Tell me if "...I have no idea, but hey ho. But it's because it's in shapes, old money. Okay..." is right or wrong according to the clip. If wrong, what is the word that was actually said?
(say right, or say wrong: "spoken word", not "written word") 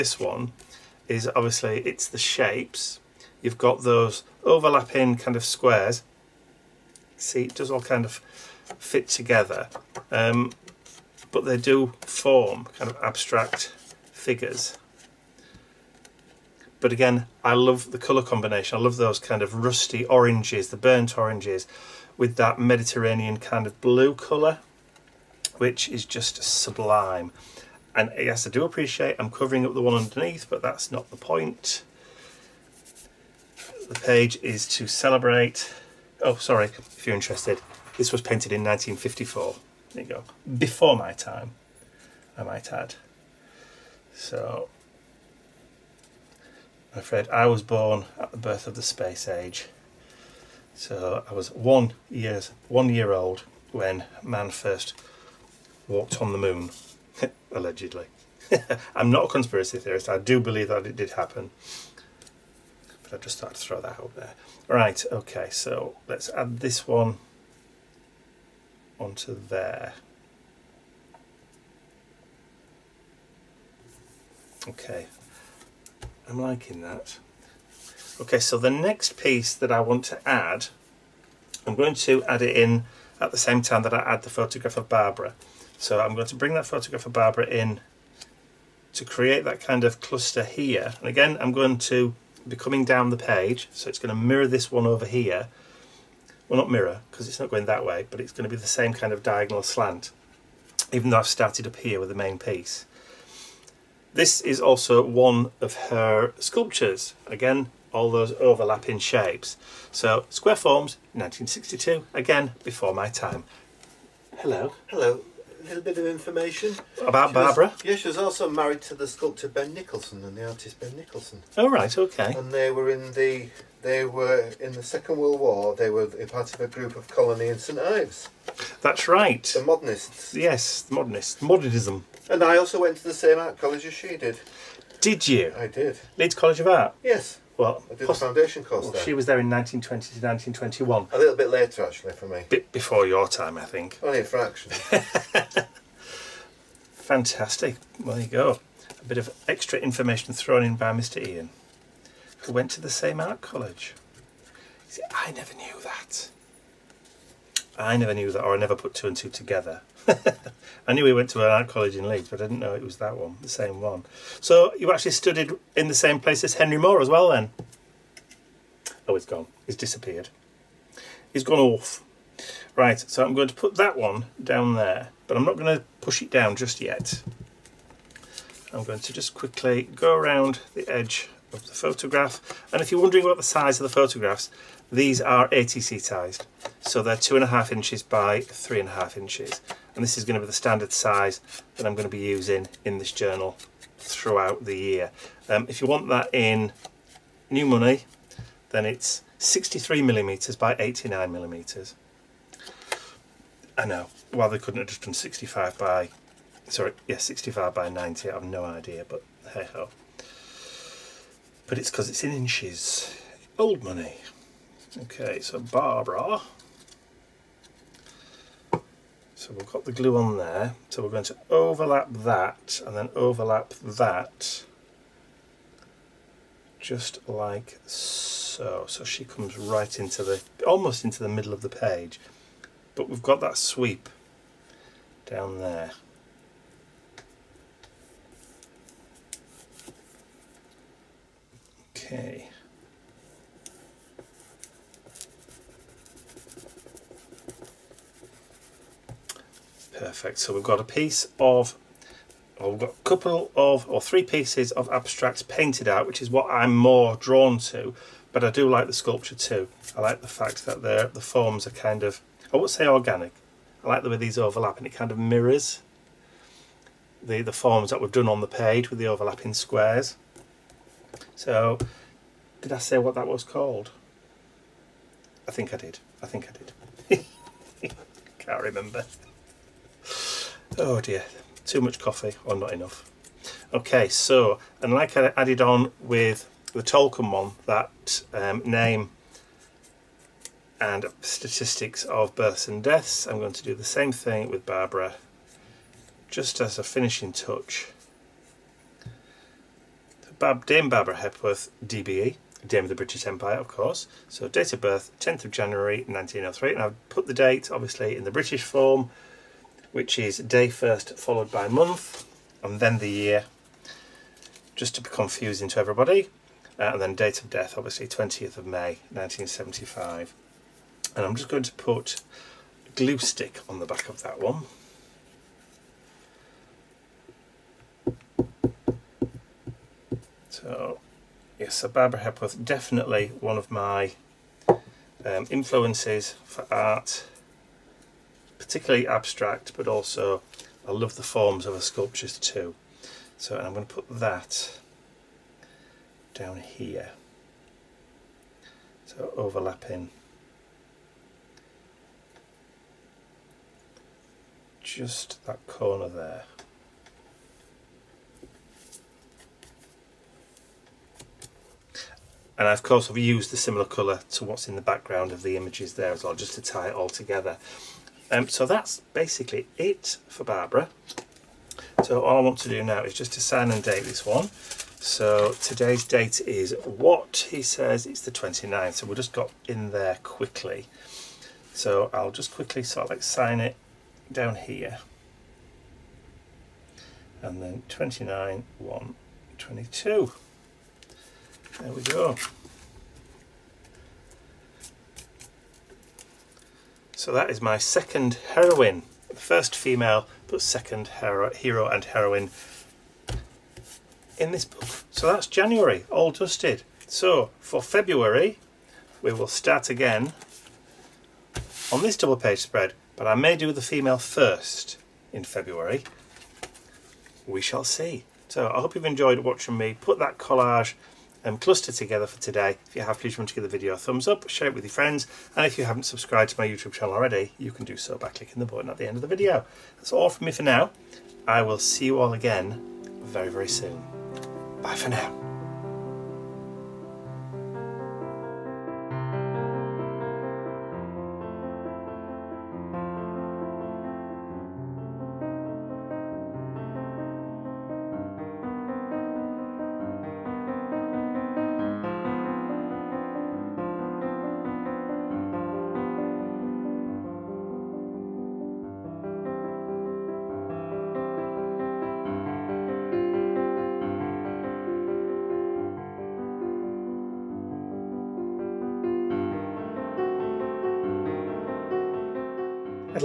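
wrong: "inches", not "shapes".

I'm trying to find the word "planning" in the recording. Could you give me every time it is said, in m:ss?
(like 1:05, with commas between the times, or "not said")
not said.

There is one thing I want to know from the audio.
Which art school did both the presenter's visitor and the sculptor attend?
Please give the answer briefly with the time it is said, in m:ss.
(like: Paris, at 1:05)
Leeds College of Art, at 2:16.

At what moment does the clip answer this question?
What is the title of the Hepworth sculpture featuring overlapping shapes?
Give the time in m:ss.
1:50.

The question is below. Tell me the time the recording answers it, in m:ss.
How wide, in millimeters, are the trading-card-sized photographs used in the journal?
3:19.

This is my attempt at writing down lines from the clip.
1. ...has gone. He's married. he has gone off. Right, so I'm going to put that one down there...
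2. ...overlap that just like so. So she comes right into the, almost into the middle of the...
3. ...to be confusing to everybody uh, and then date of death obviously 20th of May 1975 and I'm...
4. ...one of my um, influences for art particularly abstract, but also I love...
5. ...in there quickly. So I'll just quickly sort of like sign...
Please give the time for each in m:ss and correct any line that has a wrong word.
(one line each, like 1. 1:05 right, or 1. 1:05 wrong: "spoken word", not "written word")
1. 2:49 wrong: "disappeared", not "married"
2. 3:43 right
3. 5:14 right
4. 5:33 right
5. 6:19 right.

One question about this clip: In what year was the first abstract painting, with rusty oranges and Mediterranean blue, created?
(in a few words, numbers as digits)
1954.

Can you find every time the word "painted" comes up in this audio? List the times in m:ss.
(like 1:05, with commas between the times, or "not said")
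0:38, 4:15.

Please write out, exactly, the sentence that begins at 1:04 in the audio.
Right, okay, so let's add this one onto there.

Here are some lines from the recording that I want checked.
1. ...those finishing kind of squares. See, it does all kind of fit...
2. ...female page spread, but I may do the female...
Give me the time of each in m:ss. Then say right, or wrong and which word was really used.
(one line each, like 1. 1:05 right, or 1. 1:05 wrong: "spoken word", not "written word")
1. 0:03 wrong: "overlapping", not "finishing"
2. 6:52 wrong: "double", not "female".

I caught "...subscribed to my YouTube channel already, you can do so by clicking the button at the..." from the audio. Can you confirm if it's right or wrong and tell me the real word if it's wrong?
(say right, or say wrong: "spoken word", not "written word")
right.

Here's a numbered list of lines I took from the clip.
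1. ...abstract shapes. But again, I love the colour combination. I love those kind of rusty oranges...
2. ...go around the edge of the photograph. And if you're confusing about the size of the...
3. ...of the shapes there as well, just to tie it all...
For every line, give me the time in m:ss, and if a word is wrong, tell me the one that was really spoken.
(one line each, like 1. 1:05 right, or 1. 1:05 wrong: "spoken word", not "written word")
1. 0:13 wrong: "figures", not "shapes"
2. 2:59 wrong: "wondering", not "confusing"
3. 6:05 wrong: "images", not "shapes".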